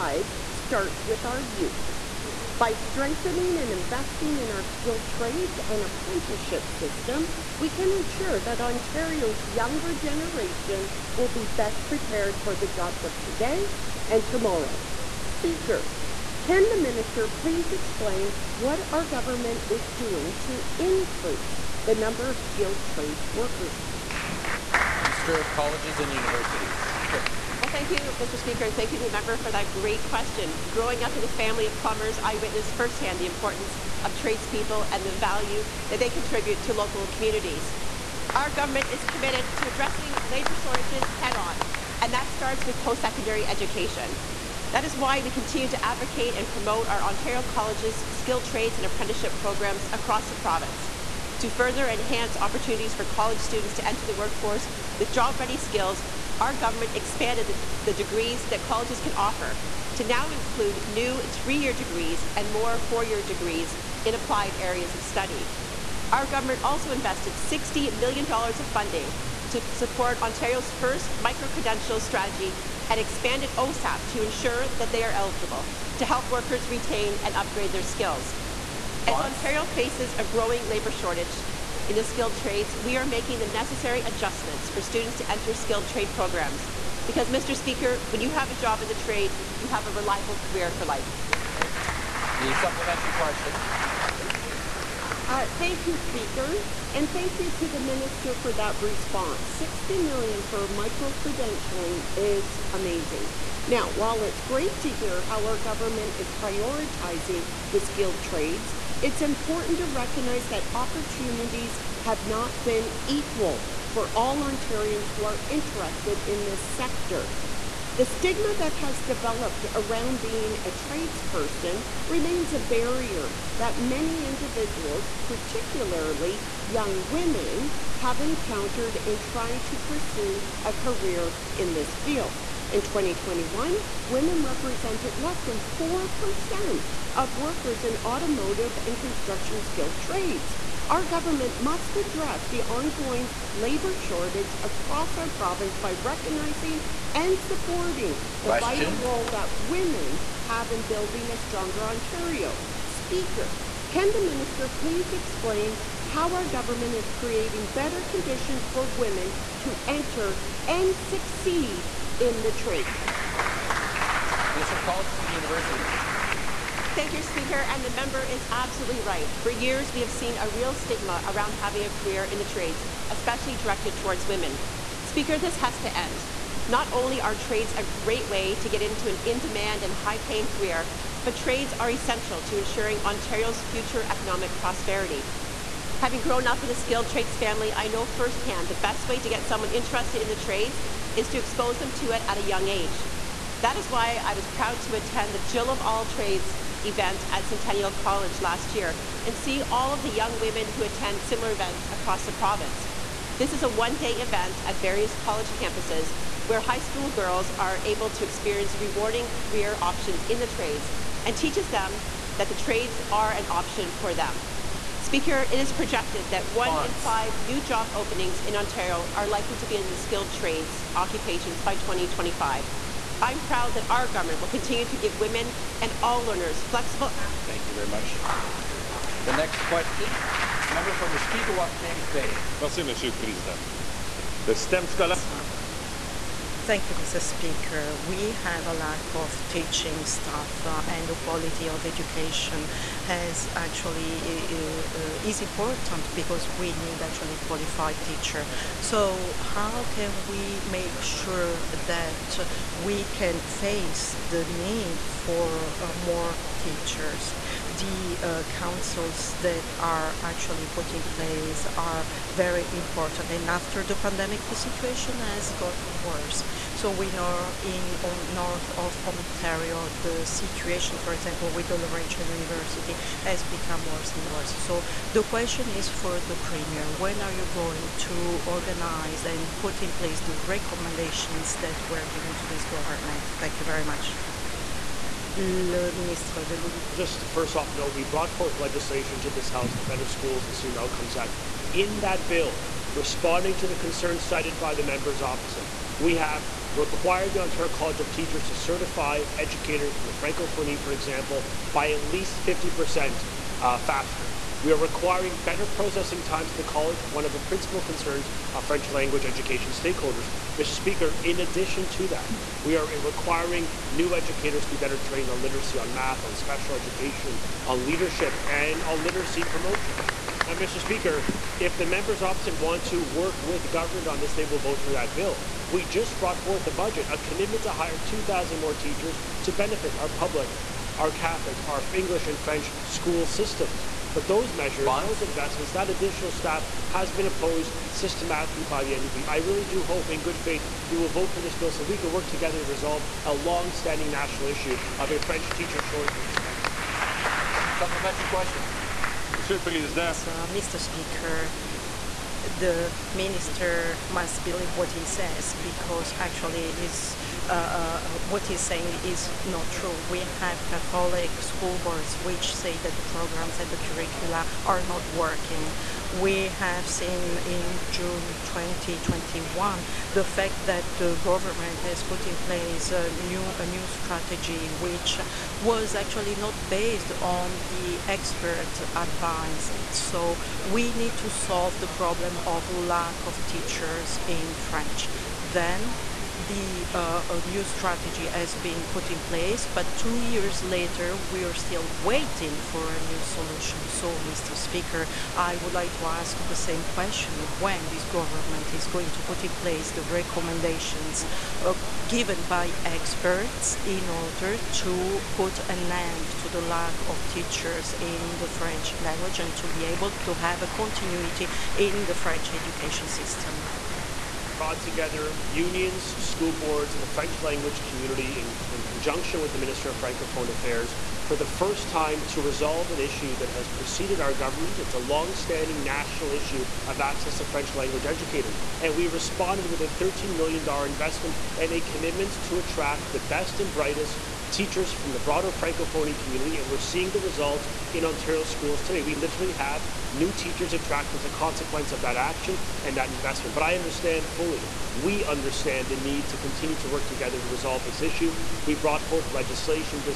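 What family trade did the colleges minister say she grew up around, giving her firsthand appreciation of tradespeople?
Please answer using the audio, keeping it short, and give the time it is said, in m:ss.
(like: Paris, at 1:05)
plumbers, at 0:31.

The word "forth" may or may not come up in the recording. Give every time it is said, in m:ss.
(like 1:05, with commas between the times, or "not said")
4:48, 5:26, 7:29.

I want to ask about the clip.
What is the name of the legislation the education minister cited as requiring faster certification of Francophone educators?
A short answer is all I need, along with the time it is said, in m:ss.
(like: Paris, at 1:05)
Better Schools and Student Outcomes Act, at 4:49.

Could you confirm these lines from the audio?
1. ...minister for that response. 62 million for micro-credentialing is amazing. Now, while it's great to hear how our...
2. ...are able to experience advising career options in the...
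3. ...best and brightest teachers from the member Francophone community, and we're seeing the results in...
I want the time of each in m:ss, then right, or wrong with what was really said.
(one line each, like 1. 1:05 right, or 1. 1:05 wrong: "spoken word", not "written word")
1. 1:37 wrong: "60", not "62"
2. 3:27 wrong: "rewarding", not "advising"
3. 7:13 wrong: "broader", not "member".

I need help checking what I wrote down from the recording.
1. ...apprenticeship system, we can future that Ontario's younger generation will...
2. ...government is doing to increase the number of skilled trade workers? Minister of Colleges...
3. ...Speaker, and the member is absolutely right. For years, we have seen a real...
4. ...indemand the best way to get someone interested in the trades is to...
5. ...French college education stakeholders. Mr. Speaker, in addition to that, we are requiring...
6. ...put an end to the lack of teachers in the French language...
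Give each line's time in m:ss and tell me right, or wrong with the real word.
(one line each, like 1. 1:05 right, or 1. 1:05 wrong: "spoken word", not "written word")
1. 0:05 wrong: "ensure", not "future"
2. 0:19 right
3. 2:47 right
4. 3:08 wrong: "firsthand", not "indemand"
5. 5:08 wrong: "language", not "college"
6. 6:45 right.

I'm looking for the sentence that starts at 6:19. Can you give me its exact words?
So we need to solve the problem problem of lack of teachers in French.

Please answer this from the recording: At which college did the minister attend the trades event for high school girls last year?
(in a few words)
Centennial College.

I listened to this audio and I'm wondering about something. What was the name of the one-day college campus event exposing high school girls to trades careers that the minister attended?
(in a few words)
Jill of All Trades.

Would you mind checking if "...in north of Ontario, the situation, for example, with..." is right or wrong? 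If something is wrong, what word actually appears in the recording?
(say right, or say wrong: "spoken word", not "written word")
right.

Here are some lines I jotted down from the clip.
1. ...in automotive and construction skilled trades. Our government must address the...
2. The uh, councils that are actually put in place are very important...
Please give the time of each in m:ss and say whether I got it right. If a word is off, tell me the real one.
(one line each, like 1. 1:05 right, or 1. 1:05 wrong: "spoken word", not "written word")
1. 2:17 right
2. 4:17 right.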